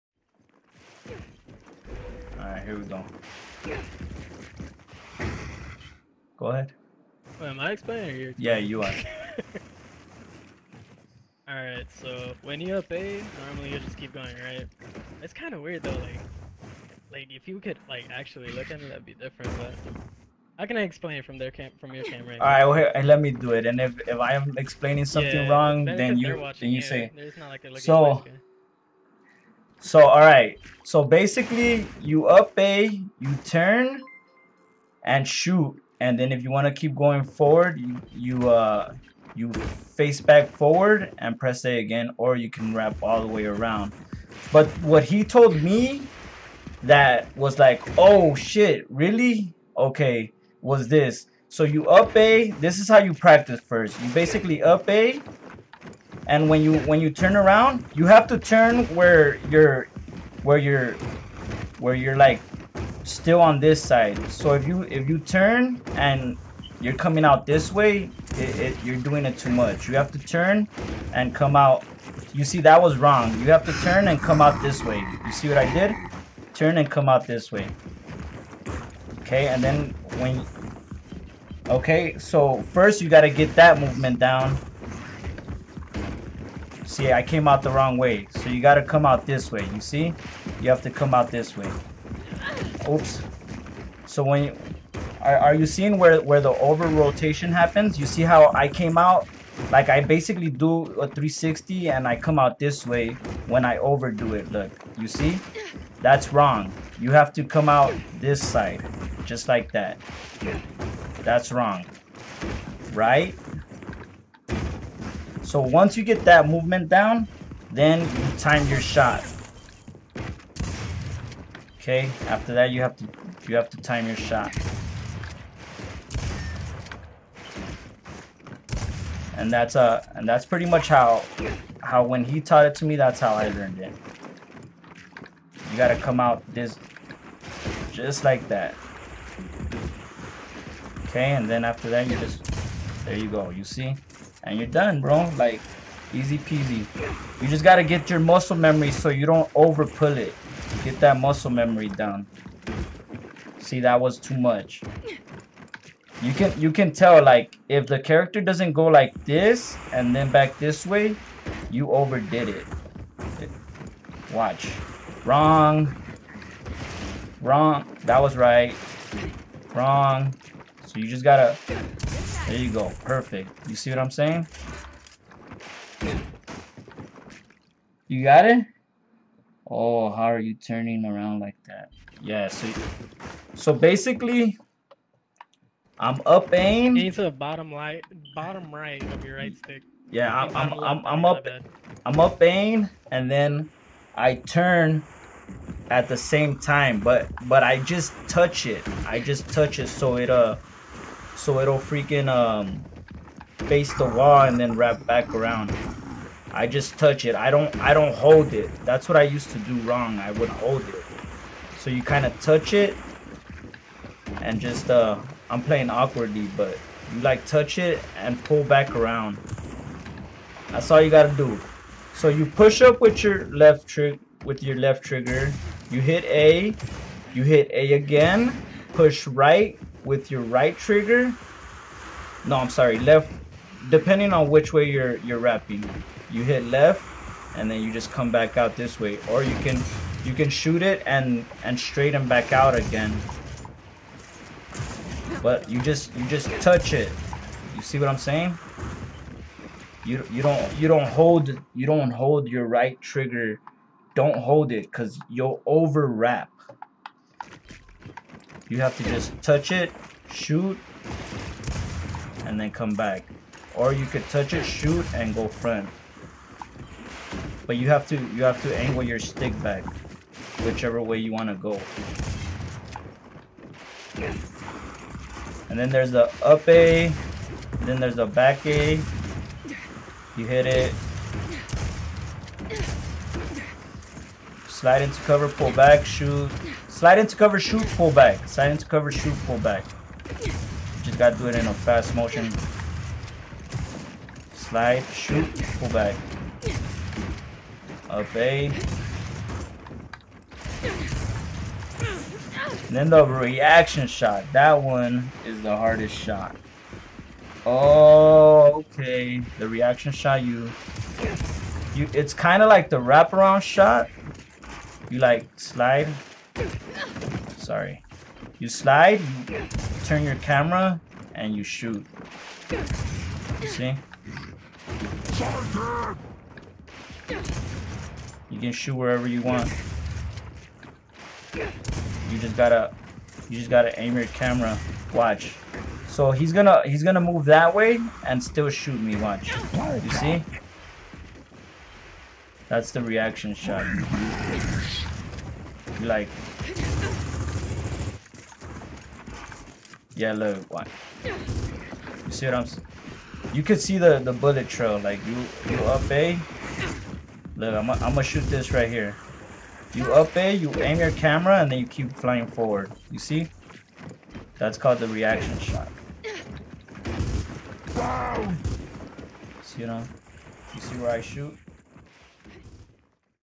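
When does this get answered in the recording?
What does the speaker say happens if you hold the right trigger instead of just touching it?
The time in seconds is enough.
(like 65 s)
254 s.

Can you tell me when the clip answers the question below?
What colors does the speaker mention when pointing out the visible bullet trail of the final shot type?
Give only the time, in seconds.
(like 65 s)
350 s.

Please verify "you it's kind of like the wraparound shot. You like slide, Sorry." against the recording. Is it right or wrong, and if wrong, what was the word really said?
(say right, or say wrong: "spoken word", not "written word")
right.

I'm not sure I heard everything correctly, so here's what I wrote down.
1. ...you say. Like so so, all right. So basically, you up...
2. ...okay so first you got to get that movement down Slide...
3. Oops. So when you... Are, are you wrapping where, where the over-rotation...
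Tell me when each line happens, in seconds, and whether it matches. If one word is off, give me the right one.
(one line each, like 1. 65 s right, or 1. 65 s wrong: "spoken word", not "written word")
1. 26 s right
2. 81 s wrong: "See", not "Slide"
3. 92 s wrong: "seeing", not "wrapping".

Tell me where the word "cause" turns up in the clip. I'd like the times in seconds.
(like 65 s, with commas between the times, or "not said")
254 s.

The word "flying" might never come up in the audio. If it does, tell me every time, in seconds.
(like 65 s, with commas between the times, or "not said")
362 s.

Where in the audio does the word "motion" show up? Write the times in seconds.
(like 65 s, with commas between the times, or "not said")
292 s.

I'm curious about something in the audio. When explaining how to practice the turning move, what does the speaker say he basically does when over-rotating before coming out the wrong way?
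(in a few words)
a 360.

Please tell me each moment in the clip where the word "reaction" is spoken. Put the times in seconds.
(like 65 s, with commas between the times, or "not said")
303 s, 309 s, 343 s, 365 s.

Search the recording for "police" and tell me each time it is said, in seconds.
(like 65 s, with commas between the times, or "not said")
not said.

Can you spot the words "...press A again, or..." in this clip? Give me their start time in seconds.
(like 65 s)
41 s.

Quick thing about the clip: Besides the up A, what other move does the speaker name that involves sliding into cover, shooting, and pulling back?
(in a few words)
back A.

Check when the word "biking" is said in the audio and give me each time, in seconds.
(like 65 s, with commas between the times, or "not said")
not said.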